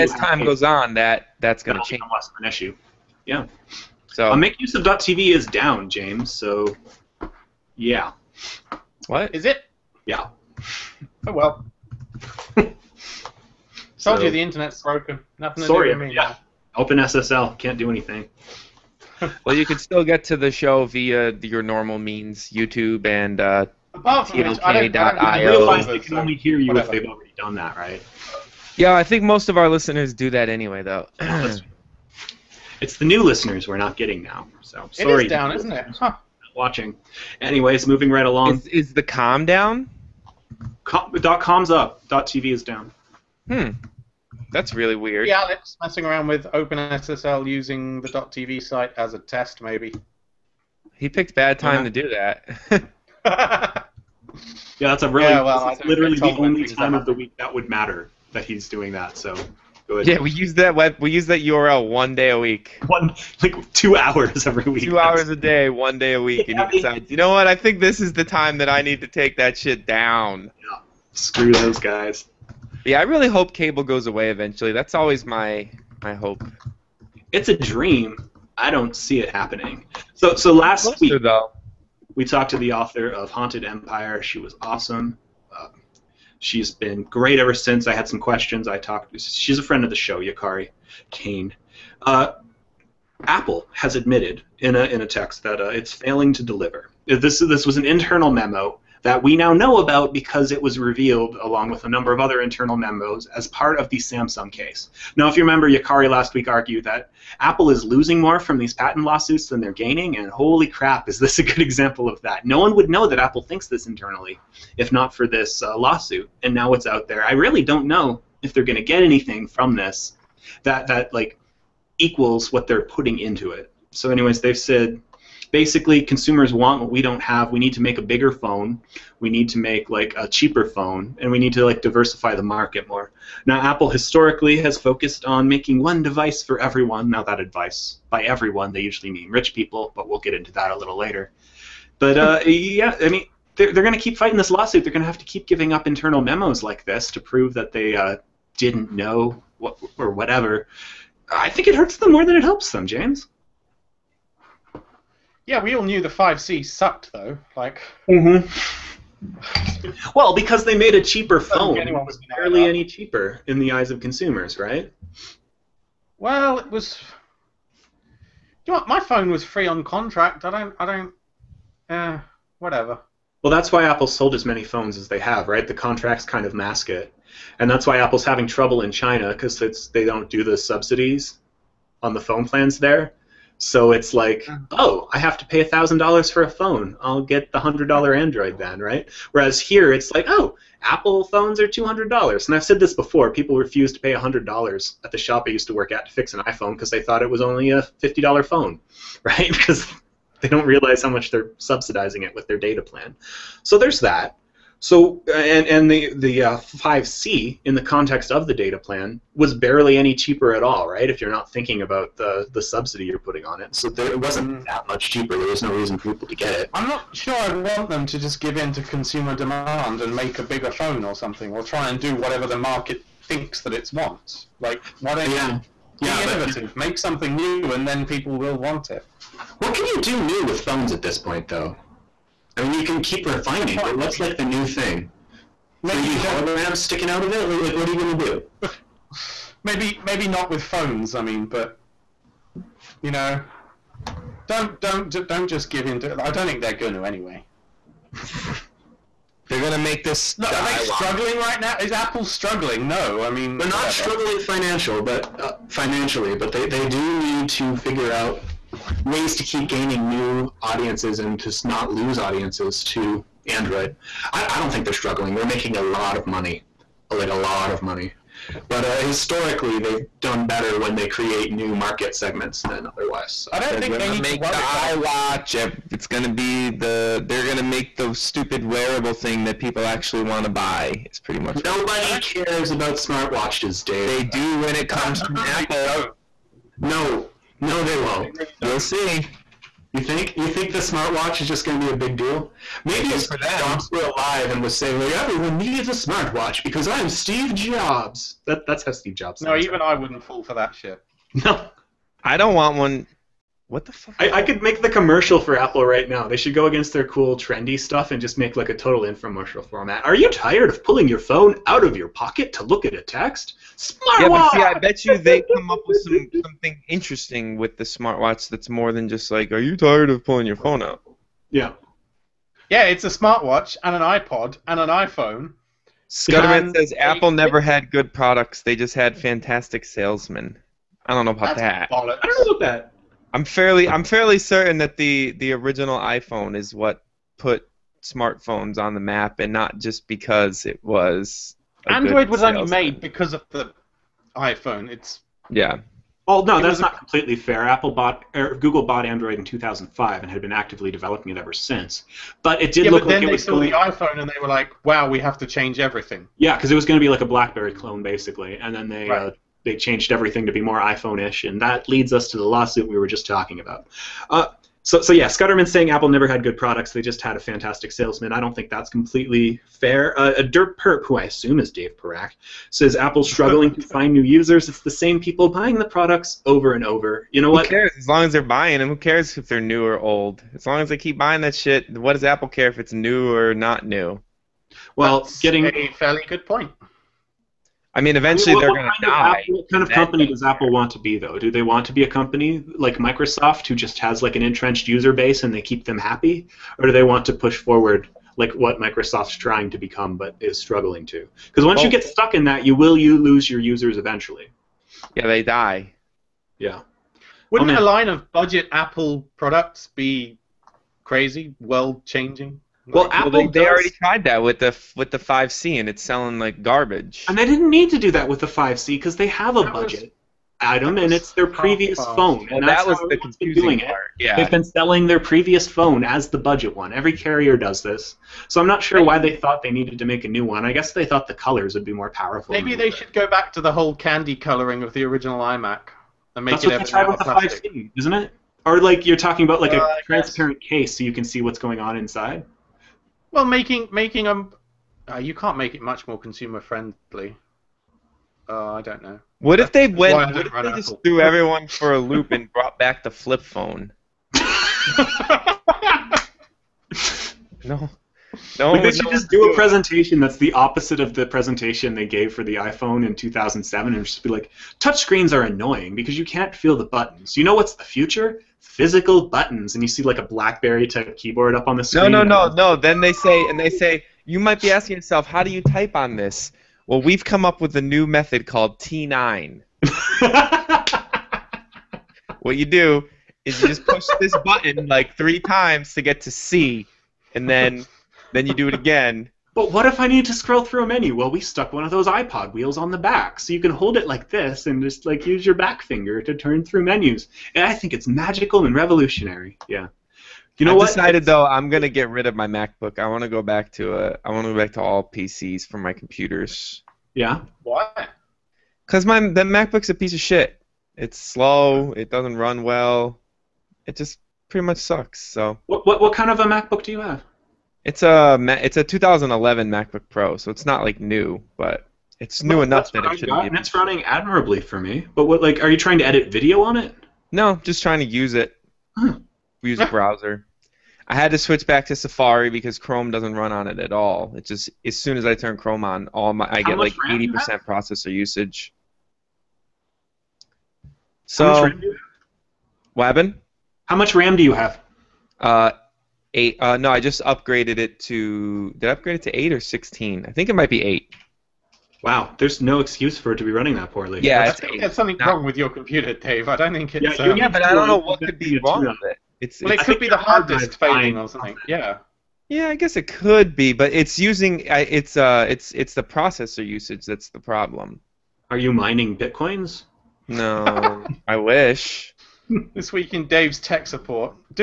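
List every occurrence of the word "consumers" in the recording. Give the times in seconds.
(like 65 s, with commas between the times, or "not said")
126 s, 163 s, 218 s, 446 s.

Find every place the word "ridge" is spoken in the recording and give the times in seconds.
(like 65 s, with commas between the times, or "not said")
not said.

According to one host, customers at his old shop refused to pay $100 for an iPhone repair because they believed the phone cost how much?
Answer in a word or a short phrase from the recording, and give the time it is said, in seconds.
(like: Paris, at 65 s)
$50, at 198 s.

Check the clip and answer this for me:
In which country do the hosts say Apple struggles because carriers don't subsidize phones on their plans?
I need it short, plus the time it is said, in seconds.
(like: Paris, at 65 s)
China, at 178 s.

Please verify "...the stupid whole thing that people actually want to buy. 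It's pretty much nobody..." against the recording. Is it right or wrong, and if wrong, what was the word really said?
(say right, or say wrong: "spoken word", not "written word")
wrong: "wearable", not "whole".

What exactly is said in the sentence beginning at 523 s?
And it's running admirably for me.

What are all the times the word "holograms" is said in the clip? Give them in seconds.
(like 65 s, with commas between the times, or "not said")
236 s.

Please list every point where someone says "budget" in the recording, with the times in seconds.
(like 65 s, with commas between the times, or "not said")
408 s, 419 s, 426 s.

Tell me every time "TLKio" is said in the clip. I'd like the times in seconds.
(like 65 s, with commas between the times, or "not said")
23 s.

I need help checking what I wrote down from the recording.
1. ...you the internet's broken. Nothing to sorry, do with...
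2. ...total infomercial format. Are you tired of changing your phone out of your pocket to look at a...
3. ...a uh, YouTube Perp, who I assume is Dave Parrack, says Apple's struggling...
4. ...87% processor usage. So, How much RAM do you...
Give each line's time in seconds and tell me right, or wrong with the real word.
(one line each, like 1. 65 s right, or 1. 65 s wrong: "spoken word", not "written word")
1. 14 s right
2. 308 s wrong: "pulling", not "changing"
3. 370 s wrong: "Dirt", not "YouTube"
4. 536 s wrong: "80", not "87".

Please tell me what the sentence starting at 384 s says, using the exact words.
Well, that's getting a fairly good point.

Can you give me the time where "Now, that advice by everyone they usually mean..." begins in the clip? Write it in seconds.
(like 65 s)
137 s.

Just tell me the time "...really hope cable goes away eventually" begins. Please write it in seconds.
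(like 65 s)
73 s.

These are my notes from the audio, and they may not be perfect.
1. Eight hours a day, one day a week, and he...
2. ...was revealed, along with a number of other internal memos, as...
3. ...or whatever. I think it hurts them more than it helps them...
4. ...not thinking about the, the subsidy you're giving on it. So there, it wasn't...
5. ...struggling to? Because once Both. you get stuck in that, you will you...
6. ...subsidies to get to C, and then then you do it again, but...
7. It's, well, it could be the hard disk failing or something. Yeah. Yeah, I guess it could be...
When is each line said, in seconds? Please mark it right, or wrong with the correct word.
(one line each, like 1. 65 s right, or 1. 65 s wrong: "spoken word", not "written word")
1. 64 s wrong: "Two", not "Eight"
2. 100 s right
3. 149 s right
4. 211 s wrong: "putting", not "giving"
5. 400 s right
6. 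485 s wrong: "times", not "subsidies"
7. 559 s right.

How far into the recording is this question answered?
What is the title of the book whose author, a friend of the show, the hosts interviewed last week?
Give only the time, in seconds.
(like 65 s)
83 s.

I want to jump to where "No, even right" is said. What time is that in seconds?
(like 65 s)
299 s.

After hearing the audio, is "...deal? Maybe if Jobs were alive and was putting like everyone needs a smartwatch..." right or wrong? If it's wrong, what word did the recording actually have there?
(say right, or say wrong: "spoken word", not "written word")
wrong: "saying", not "putting".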